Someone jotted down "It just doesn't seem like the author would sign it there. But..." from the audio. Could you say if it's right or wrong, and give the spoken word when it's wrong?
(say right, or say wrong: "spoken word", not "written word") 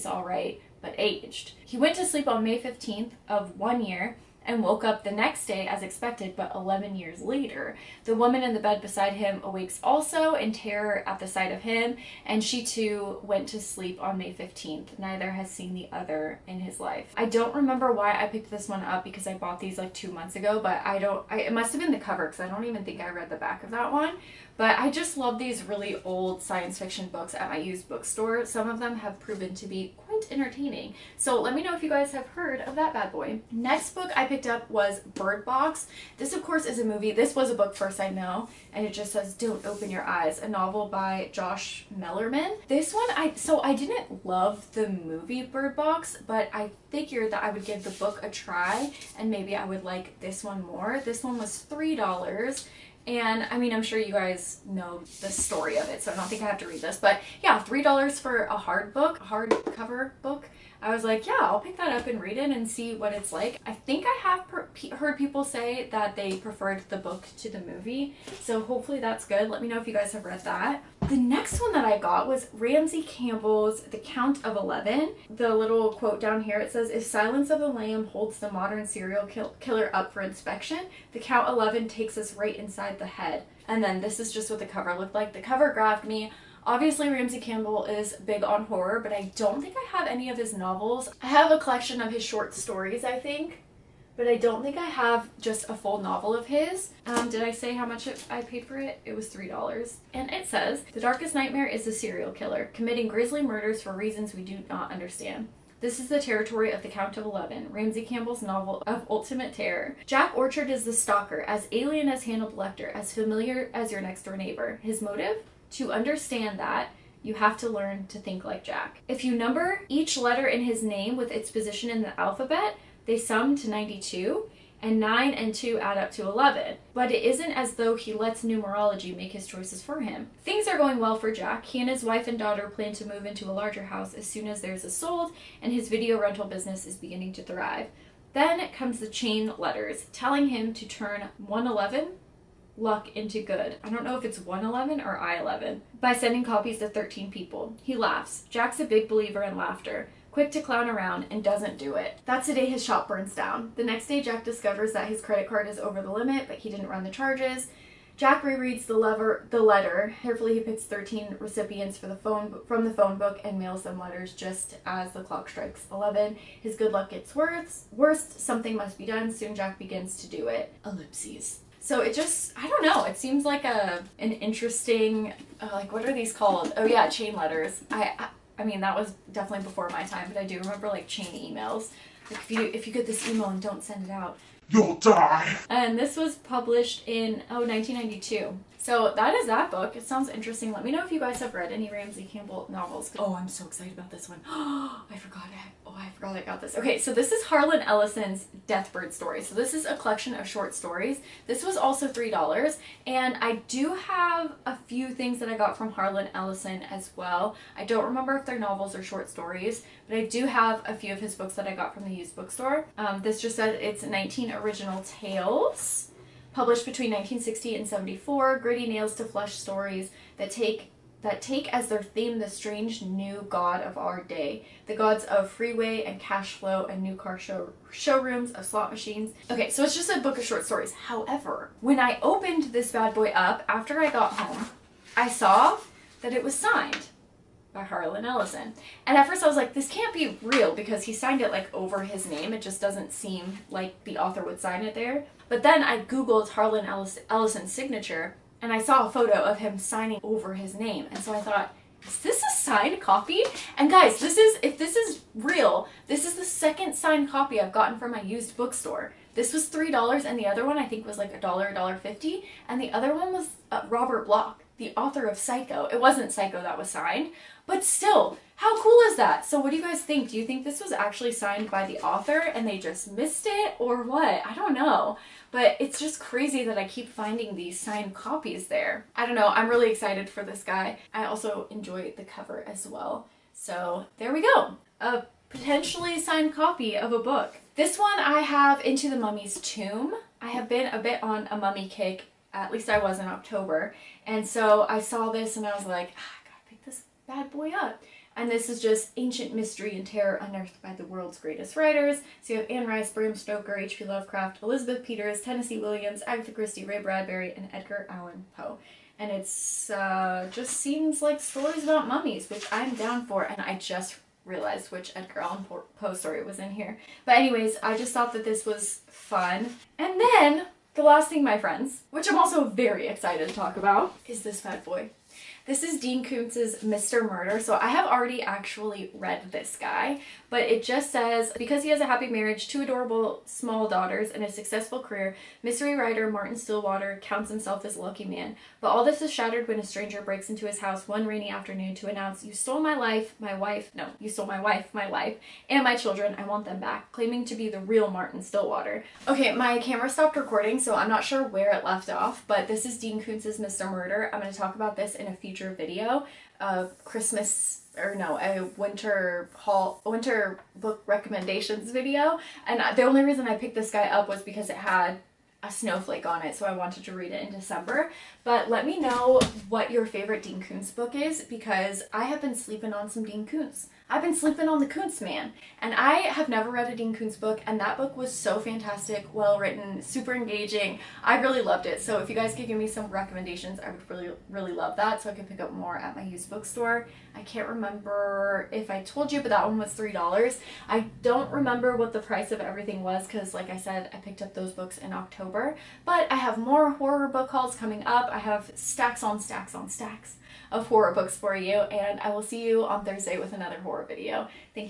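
right.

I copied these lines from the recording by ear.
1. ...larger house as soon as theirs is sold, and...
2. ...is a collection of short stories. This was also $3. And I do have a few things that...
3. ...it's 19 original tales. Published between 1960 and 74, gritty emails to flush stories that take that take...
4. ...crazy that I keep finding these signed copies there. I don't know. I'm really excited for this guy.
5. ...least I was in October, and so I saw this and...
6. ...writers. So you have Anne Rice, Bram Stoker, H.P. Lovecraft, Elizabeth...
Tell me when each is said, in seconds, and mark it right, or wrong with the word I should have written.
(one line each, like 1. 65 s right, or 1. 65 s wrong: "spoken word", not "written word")
1. 133 s right
2. 199 s right
3. 213 s wrong: "nails", not "emails"
4. 276 s right
5. 292 s right
6. 301 s right.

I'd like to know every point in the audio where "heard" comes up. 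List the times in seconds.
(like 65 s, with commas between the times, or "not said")
32 s, 64 s.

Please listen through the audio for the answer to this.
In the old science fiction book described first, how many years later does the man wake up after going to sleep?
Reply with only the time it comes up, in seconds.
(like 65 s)
6 s.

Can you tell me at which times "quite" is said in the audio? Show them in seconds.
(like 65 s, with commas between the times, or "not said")
29 s.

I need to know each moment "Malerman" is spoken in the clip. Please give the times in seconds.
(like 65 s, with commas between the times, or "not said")
41 s.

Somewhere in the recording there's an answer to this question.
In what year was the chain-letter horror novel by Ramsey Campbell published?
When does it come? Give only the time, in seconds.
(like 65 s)
187 s.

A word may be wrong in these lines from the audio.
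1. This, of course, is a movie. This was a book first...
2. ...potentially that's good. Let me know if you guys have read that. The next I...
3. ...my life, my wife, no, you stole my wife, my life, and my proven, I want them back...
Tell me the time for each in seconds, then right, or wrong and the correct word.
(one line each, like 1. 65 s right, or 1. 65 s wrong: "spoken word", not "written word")
1. 36 s right
2. 68 s wrong: "hopefully", not "potentially"
3. 342 s wrong: "children", not "proven".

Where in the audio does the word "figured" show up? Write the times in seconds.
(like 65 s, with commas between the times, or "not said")
46 s.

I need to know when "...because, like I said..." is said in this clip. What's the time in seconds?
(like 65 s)
393 s.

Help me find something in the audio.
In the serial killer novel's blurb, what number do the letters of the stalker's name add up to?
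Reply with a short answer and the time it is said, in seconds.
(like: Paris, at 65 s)
92, at 123 s.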